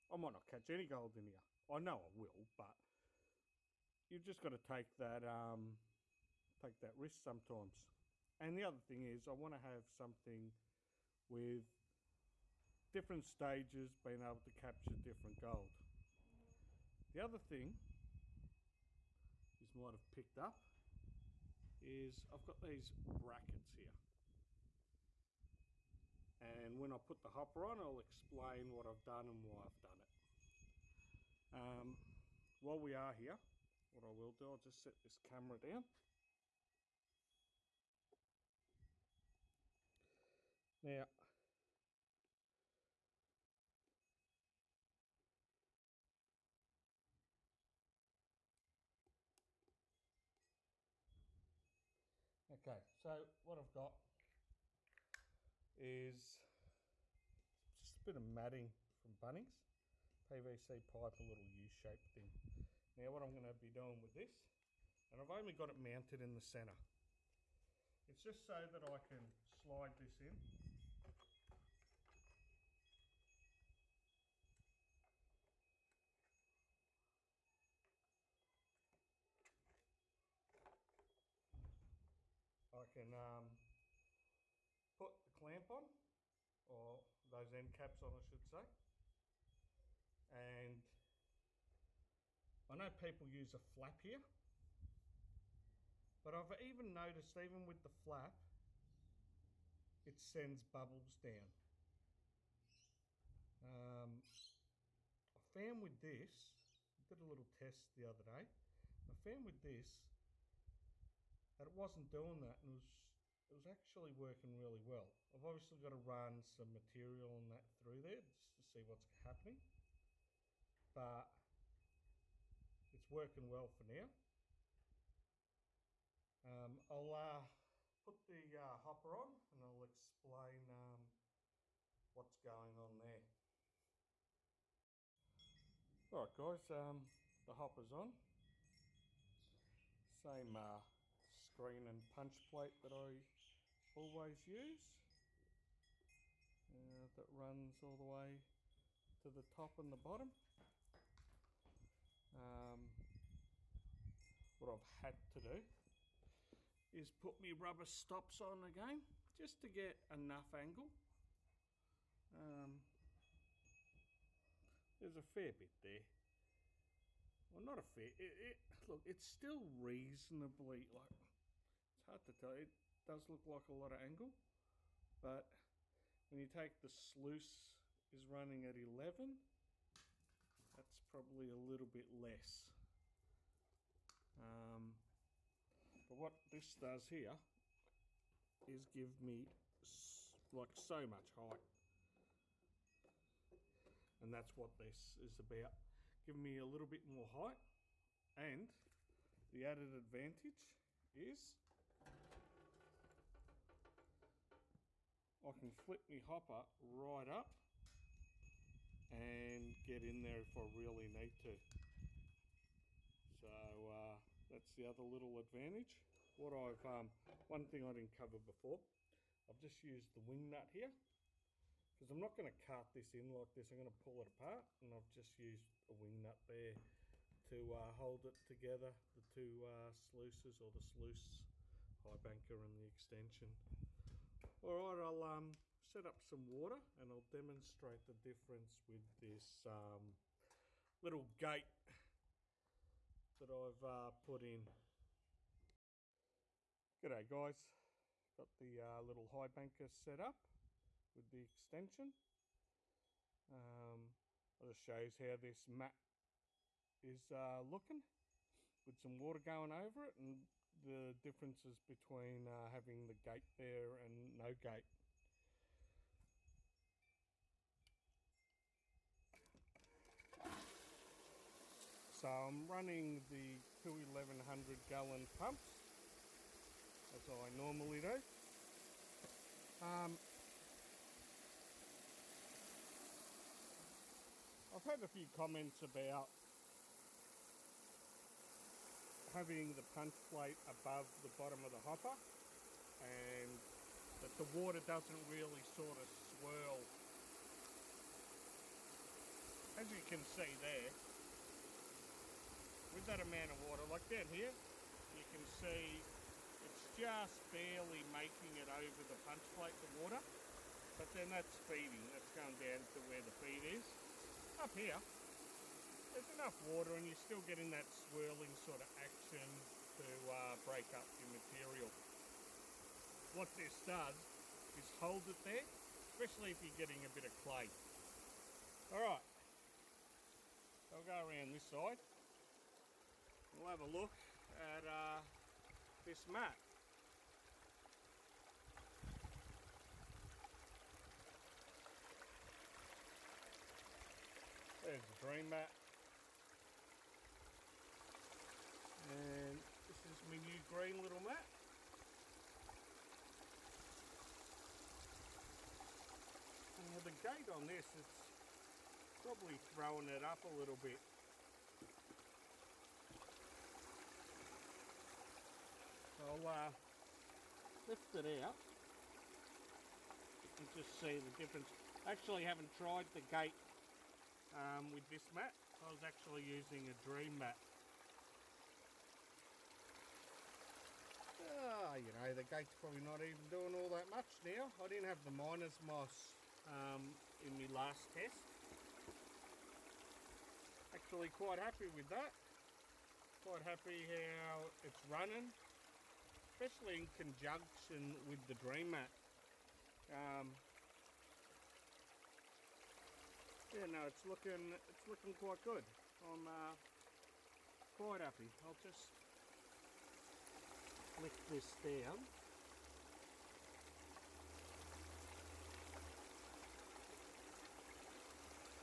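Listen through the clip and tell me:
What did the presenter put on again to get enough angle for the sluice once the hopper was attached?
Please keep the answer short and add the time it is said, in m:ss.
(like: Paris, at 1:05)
rubber stops, at 2:37.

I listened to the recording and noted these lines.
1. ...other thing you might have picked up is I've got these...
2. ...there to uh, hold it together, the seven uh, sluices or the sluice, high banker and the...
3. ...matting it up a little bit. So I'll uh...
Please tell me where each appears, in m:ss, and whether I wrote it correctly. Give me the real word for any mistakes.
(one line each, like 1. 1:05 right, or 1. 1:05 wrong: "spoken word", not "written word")
1. 0:17 right
2. 3:46 wrong: "two", not "seven"
3. 5:59 wrong: "throwing", not "matting".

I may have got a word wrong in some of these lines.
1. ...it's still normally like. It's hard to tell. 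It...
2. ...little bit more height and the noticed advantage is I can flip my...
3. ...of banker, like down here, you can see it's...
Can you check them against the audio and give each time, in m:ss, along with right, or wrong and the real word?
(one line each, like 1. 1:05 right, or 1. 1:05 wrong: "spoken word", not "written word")
1. 2:49 wrong: "reasonably", not "normally"
2. 3:16 wrong: "added", not "noticed"
3. 5:03 wrong: "water", not "banker".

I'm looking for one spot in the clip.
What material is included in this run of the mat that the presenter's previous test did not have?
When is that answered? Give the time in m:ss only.
6:25.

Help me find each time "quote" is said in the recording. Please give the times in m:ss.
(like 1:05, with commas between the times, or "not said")
not said.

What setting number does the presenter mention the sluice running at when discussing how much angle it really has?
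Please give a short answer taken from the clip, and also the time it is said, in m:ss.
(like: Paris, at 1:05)
11, at 2:58.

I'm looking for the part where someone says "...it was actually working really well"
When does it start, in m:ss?
1:53.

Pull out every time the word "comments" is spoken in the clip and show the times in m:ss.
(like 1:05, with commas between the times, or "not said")
4:45.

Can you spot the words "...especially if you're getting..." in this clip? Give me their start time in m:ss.
5:25.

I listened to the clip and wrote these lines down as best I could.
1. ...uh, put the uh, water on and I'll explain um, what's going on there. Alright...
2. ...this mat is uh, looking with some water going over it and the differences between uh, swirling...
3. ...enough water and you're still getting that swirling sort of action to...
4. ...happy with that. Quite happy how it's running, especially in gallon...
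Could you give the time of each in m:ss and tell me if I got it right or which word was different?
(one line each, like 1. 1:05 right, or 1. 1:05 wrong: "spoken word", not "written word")
1. 2:07 wrong: "hopper", not "water"
2. 4:15 wrong: "having", not "swirling"
3. 5:16 right
4. 6:31 wrong: "conjunction", not "gallon".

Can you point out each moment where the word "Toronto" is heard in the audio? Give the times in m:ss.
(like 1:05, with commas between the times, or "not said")
not said.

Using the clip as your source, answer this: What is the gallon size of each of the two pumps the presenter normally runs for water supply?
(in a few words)
1100 gallon.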